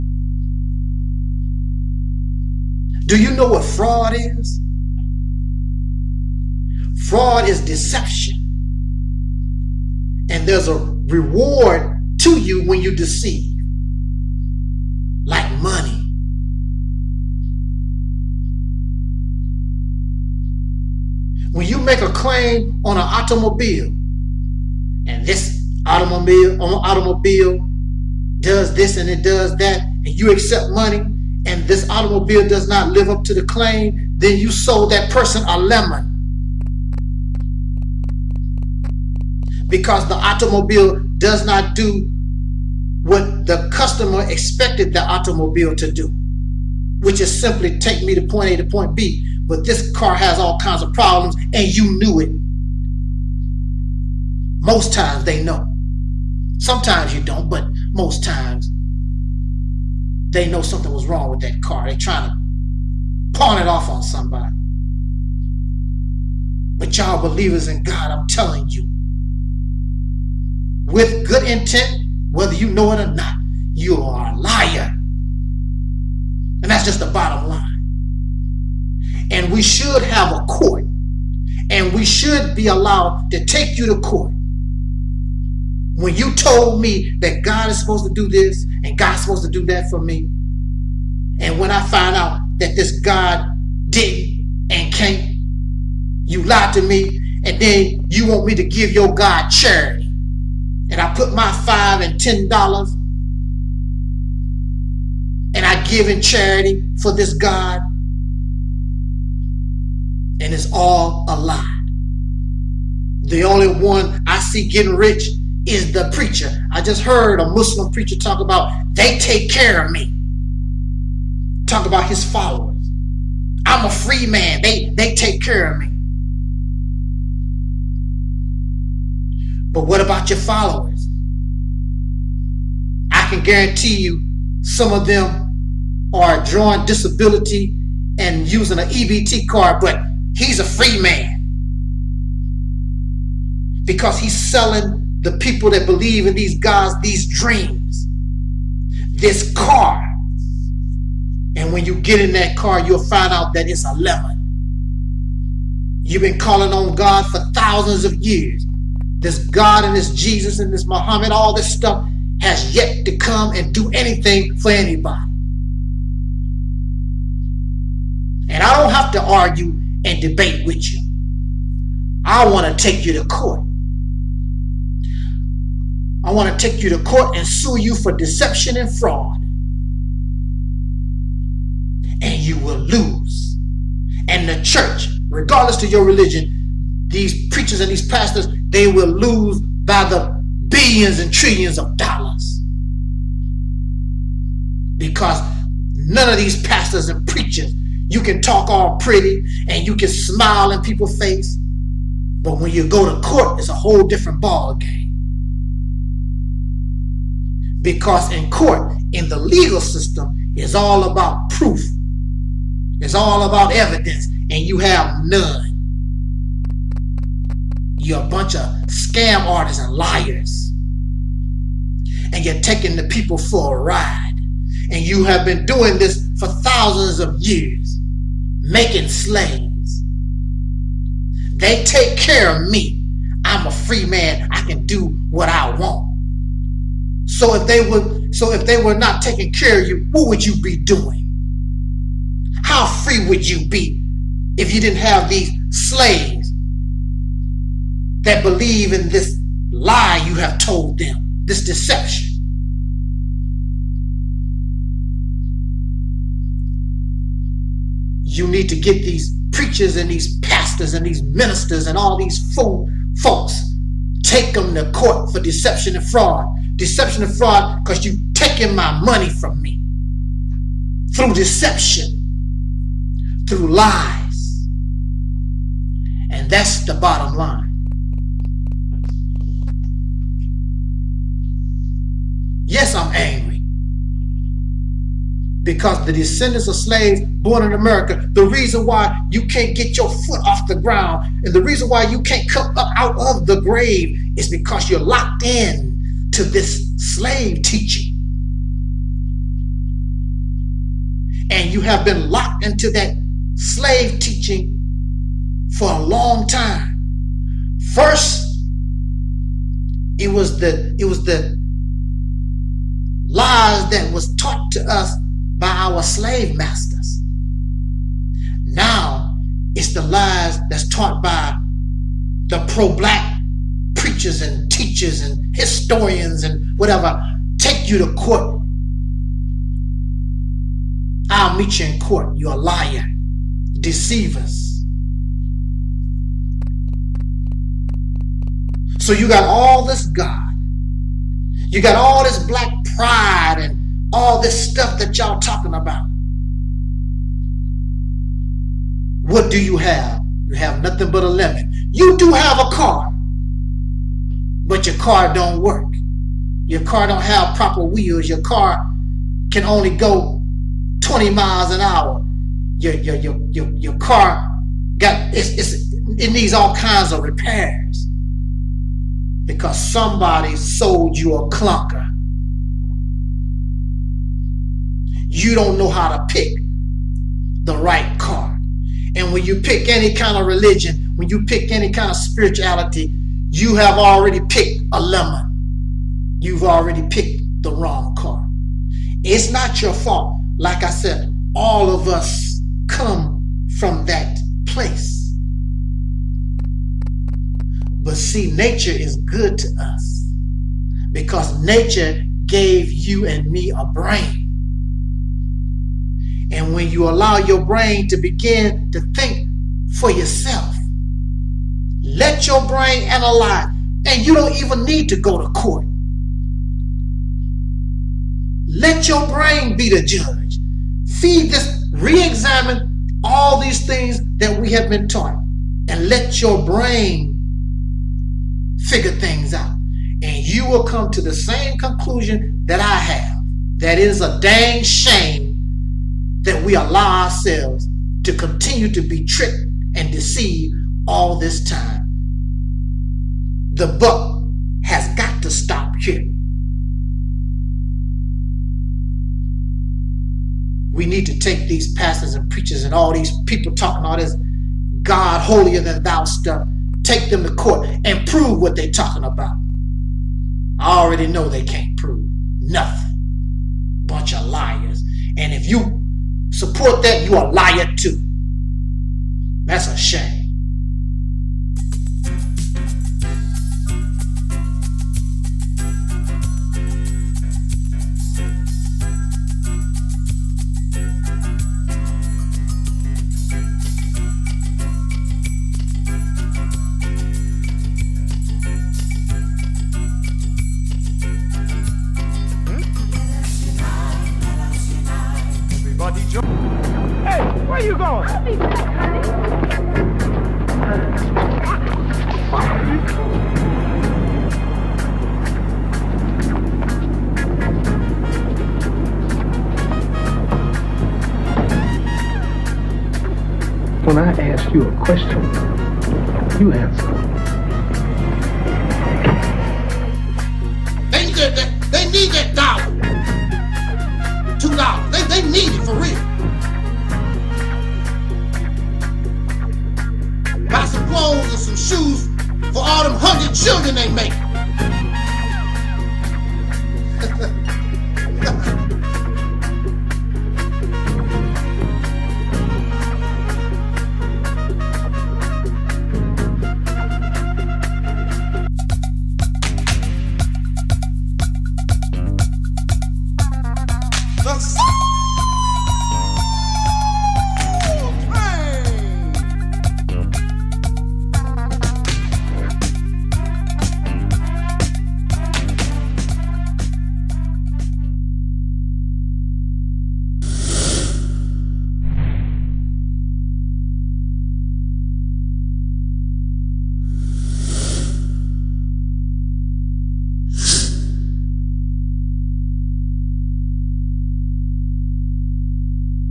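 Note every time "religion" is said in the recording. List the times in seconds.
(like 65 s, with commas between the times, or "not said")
186 s, 380 s.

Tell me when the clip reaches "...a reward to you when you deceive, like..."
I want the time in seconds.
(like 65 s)
10 s.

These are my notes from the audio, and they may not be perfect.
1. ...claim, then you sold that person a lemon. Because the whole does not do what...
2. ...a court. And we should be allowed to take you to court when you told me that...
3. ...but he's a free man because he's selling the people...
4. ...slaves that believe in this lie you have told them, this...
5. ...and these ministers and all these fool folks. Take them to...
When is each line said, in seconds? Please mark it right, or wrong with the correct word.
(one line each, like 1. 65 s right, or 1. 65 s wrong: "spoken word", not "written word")
1. 33 s wrong: "automobile", not "whole"
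2. 80 s right
3. 139 s right
4. 245 s right
5. 260 s right.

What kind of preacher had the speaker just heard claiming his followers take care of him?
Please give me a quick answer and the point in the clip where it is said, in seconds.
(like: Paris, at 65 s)
Muslim preacher, at 117 s.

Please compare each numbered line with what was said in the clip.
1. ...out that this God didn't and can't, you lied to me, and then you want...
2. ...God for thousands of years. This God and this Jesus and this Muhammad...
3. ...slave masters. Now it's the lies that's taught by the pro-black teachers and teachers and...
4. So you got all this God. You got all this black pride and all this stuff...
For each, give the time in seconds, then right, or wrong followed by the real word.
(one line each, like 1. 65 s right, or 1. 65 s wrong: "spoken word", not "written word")
1. 92 s right
2. 156 s right
3. 316 s wrong: "preachers", not "teachers"
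4. 338 s right.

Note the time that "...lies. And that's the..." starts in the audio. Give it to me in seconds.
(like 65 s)
273 s.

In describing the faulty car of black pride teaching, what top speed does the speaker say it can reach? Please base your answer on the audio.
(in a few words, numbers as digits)
20 miles an hour.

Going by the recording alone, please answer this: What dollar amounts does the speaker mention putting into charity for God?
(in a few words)
5 and 10 dollars.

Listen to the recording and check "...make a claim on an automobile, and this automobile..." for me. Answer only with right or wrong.
right.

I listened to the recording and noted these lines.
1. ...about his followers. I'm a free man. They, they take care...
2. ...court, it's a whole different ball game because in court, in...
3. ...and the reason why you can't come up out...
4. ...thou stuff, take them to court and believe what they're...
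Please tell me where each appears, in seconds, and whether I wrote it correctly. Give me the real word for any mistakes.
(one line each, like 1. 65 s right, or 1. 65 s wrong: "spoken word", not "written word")
1. 121 s right
2. 203 s right
3. 291 s right
4. 456 s wrong: "prove", not "believe".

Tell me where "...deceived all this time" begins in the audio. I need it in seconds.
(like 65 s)
440 s.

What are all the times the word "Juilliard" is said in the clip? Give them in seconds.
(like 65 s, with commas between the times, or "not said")
not said.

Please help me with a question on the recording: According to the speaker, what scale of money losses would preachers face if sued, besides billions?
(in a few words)
trillions.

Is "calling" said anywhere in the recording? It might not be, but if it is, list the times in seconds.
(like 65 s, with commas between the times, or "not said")
156 s.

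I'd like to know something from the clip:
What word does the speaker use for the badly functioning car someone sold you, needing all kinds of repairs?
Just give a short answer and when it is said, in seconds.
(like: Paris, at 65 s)
clunker, at 371 s.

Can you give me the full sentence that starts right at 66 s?
But y'all believers in God, I'm telling you, with good intent, whether you know it or not, you are a liar.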